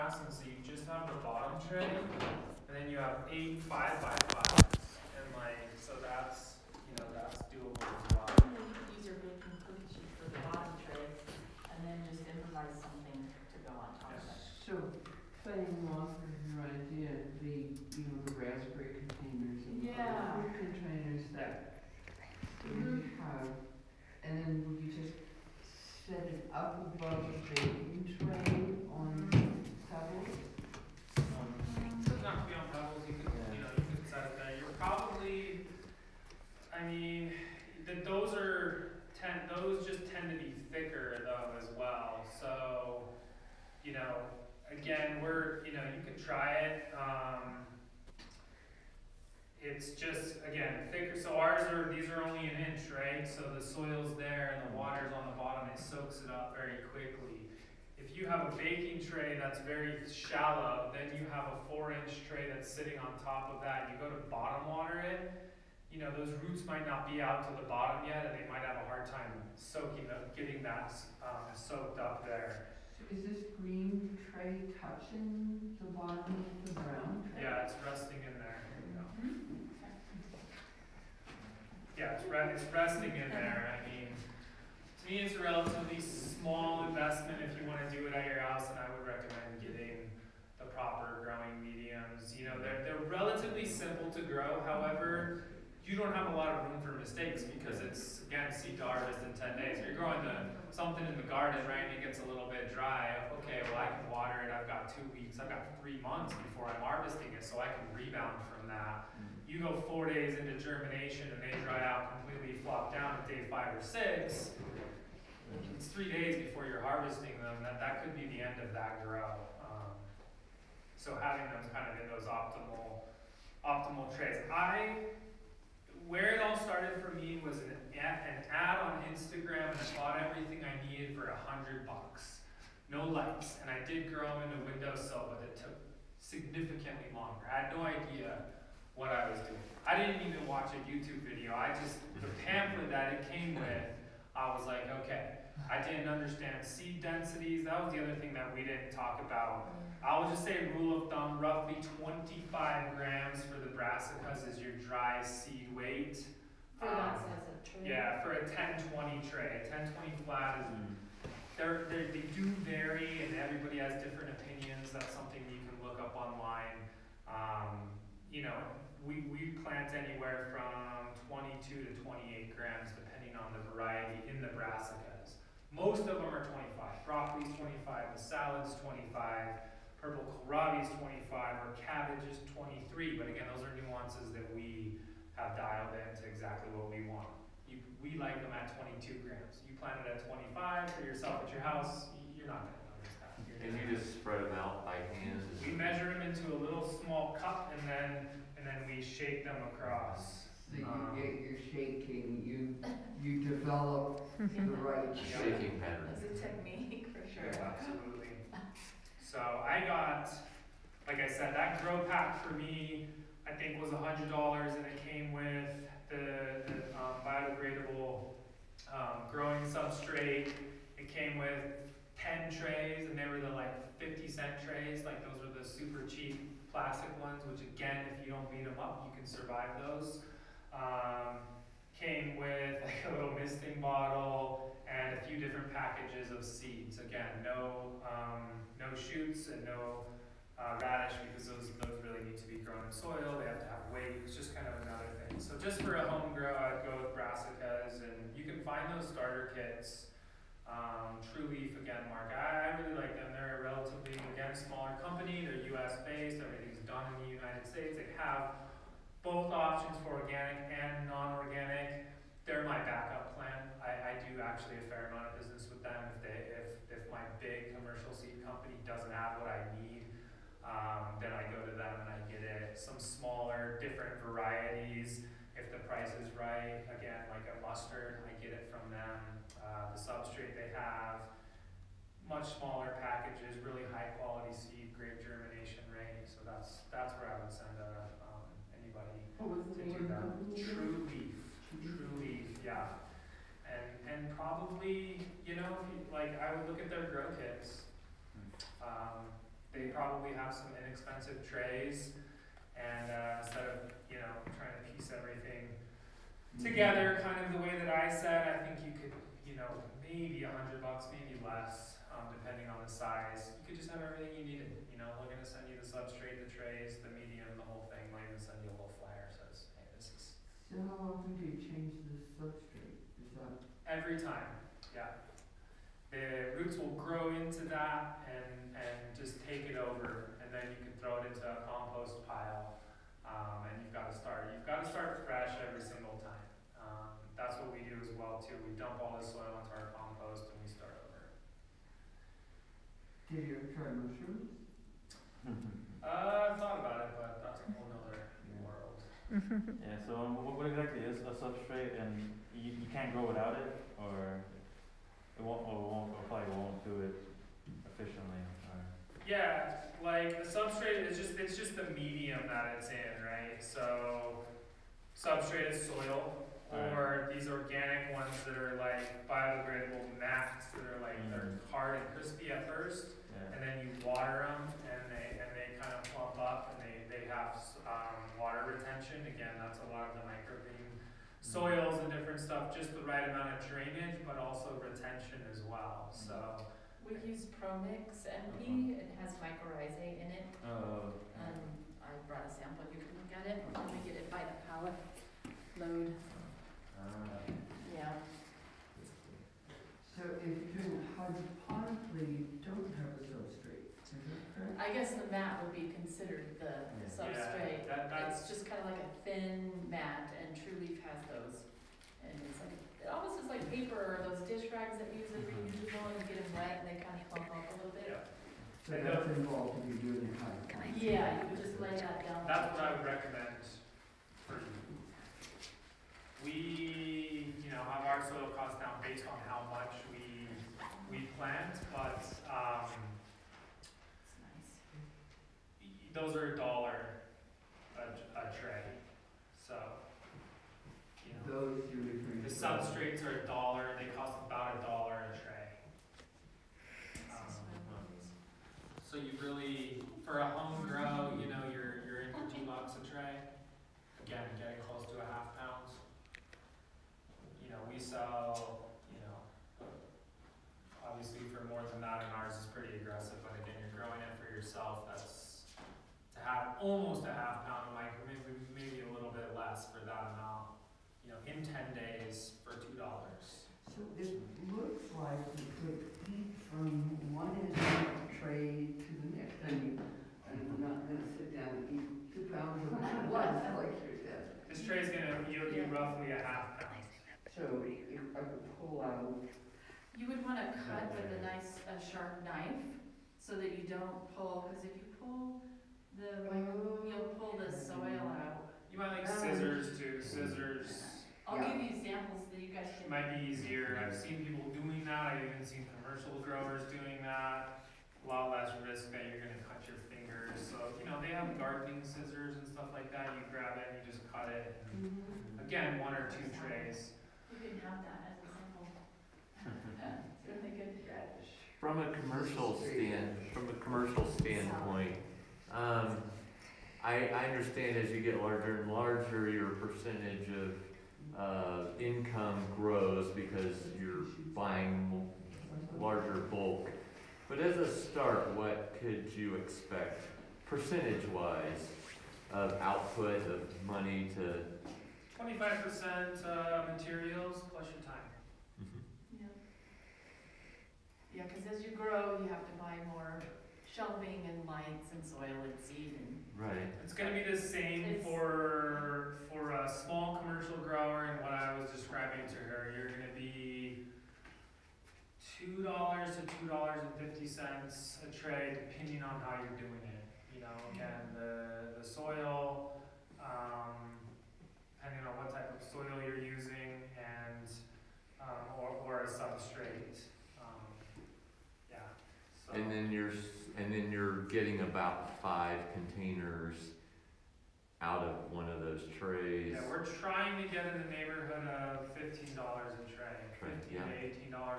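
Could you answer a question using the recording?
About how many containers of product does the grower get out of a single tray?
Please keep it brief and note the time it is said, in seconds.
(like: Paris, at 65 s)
5, at 585 s.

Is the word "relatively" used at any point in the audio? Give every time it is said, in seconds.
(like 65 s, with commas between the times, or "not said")
85 s, 93 s, 253 s.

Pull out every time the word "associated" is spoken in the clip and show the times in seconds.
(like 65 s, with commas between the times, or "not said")
not said.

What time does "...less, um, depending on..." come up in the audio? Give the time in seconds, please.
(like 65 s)
311 s.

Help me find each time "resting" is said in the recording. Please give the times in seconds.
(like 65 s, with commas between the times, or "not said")
77 s, 82 s.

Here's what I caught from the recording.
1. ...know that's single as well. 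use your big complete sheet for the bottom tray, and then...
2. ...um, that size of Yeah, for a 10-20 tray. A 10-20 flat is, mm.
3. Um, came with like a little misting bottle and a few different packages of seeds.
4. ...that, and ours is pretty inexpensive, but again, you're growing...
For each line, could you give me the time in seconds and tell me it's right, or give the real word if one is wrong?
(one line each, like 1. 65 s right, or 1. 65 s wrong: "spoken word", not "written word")
1. 7 s wrong: "doable", not "single"
2. 156 s right
3. 230 s right
4. 462 s wrong: "aggressive", not "inexpensive".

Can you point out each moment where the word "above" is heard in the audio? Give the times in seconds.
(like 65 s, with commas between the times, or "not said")
26 s.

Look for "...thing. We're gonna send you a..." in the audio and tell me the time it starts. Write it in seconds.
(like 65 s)
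317 s.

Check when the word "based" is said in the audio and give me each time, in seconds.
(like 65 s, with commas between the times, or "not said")
256 s, 429 s.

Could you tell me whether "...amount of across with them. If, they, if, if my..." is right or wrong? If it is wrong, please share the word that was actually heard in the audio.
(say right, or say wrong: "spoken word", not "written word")
wrong: "business", not "across".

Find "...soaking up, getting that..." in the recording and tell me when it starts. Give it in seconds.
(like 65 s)
69 s.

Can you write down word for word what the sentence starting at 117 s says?
That, that could be the end of that grow.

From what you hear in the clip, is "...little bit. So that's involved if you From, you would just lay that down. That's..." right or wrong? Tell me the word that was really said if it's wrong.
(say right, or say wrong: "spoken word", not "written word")
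wrong: "Yeah", not "From".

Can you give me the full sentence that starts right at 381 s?
soils and different stuff, just the right amount of drainage, but also retention as well.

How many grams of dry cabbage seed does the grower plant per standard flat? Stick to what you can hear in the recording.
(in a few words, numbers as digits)
23.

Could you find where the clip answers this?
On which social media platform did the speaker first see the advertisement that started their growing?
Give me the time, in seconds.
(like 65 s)
129 s.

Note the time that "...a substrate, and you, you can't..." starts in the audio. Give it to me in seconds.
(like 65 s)
351 s.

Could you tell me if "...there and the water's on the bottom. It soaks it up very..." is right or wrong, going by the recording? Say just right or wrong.
right.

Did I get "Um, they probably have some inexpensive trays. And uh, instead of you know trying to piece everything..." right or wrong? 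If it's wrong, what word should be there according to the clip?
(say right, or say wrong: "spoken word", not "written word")
right.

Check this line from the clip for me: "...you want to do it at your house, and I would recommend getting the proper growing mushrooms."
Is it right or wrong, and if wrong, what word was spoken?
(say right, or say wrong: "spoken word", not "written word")
wrong: "mediums", not "mushrooms".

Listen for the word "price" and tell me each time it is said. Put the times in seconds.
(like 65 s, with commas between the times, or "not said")
275 s.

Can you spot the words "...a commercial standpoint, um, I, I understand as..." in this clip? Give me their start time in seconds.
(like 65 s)
523 s.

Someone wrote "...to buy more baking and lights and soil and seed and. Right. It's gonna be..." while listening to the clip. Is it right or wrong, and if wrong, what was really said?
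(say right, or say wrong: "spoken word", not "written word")
wrong: "shelving", not "baking".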